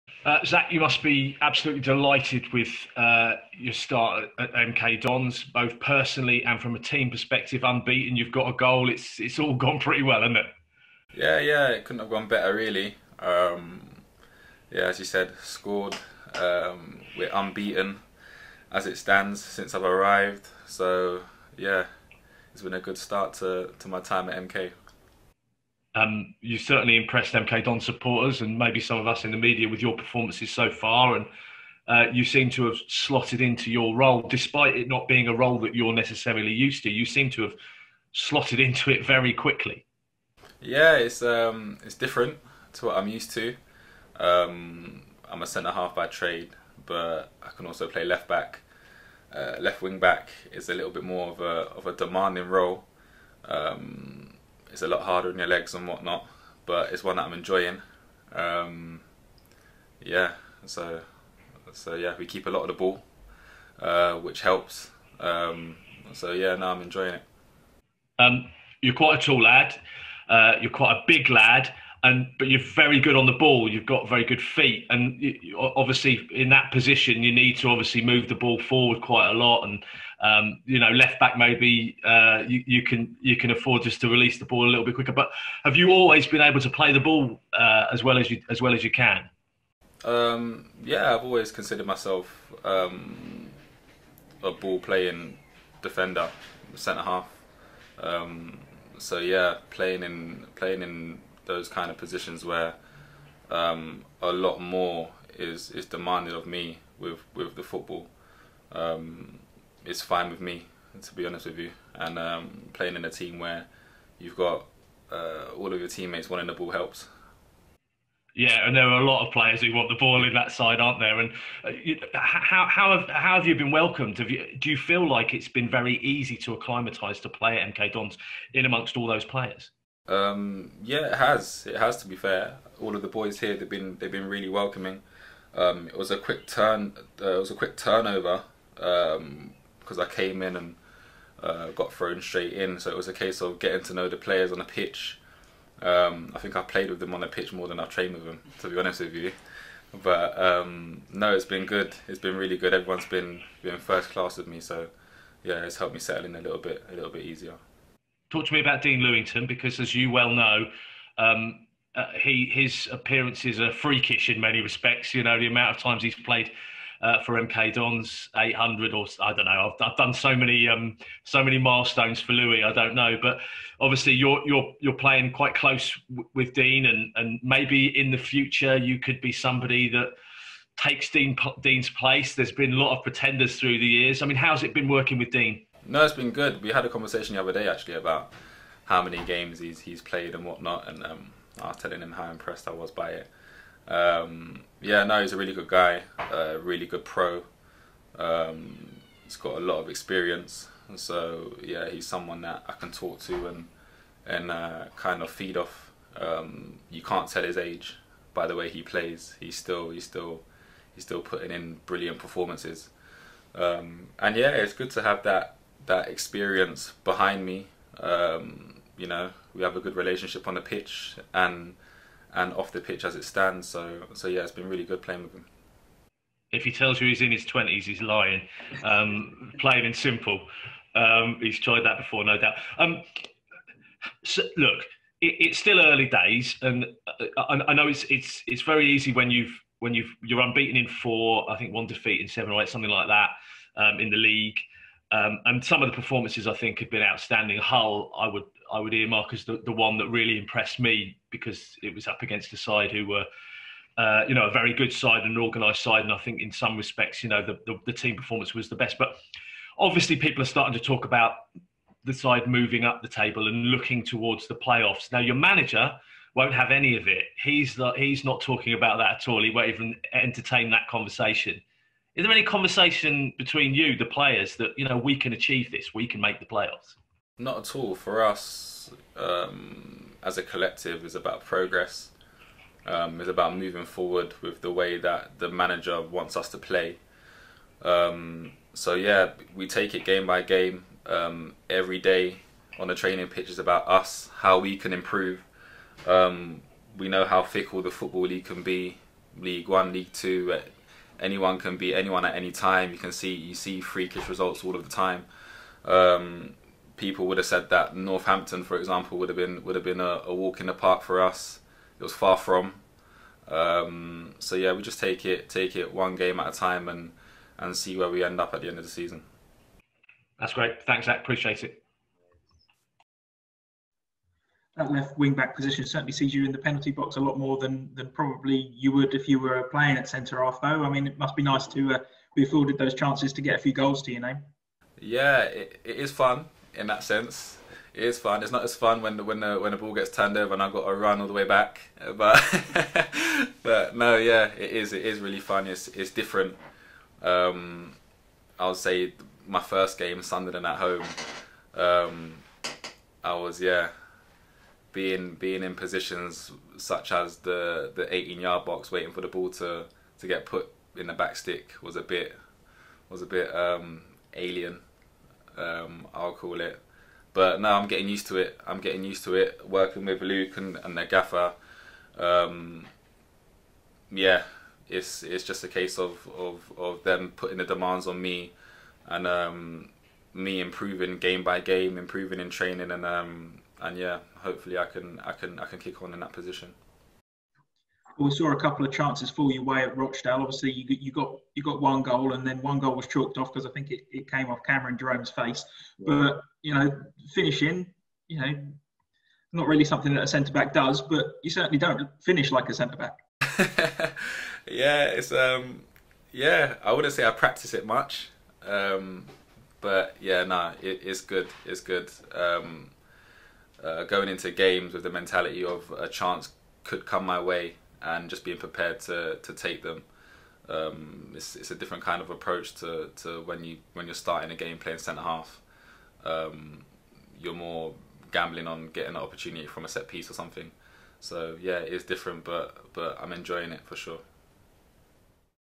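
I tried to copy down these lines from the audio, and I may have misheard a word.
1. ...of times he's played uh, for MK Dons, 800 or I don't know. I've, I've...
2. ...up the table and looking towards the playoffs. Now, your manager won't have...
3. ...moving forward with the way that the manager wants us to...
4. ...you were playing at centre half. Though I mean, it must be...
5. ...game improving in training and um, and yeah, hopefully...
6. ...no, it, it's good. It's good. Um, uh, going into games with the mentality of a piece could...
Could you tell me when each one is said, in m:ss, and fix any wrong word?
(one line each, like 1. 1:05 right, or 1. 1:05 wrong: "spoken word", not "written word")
1. 2:45 right
2. 4:22 right
3. 4:43 right
4. 5:29 right
5. 6:21 right
6. 6:50 wrong: "chance", not "piece".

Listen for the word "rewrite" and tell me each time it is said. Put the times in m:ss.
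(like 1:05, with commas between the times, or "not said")
not said.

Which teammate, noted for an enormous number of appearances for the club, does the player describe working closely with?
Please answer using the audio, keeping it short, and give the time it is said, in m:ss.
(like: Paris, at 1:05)
Dean Lewington, at 2:38.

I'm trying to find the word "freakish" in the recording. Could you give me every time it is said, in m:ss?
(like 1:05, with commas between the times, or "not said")
2:43, 5:03.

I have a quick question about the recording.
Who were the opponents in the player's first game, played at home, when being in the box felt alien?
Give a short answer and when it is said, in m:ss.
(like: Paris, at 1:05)
Sunderland, at 5:50.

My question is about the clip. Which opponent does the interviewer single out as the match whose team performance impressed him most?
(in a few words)
Hull.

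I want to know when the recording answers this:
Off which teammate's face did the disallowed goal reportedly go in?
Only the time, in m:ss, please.
6:34.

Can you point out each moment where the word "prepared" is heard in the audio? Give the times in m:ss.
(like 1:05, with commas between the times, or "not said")
6:58.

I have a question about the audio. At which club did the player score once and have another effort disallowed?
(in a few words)
Rochdale.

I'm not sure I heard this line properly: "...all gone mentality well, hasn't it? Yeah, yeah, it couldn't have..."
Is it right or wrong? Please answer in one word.
wrong.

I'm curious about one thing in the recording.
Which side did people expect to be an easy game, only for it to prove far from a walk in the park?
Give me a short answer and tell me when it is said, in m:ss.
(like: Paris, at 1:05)
Northampton, at 5:07.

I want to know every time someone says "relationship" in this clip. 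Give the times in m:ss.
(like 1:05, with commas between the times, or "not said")
3:39.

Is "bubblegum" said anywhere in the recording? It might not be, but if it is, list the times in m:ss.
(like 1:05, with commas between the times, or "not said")
not said.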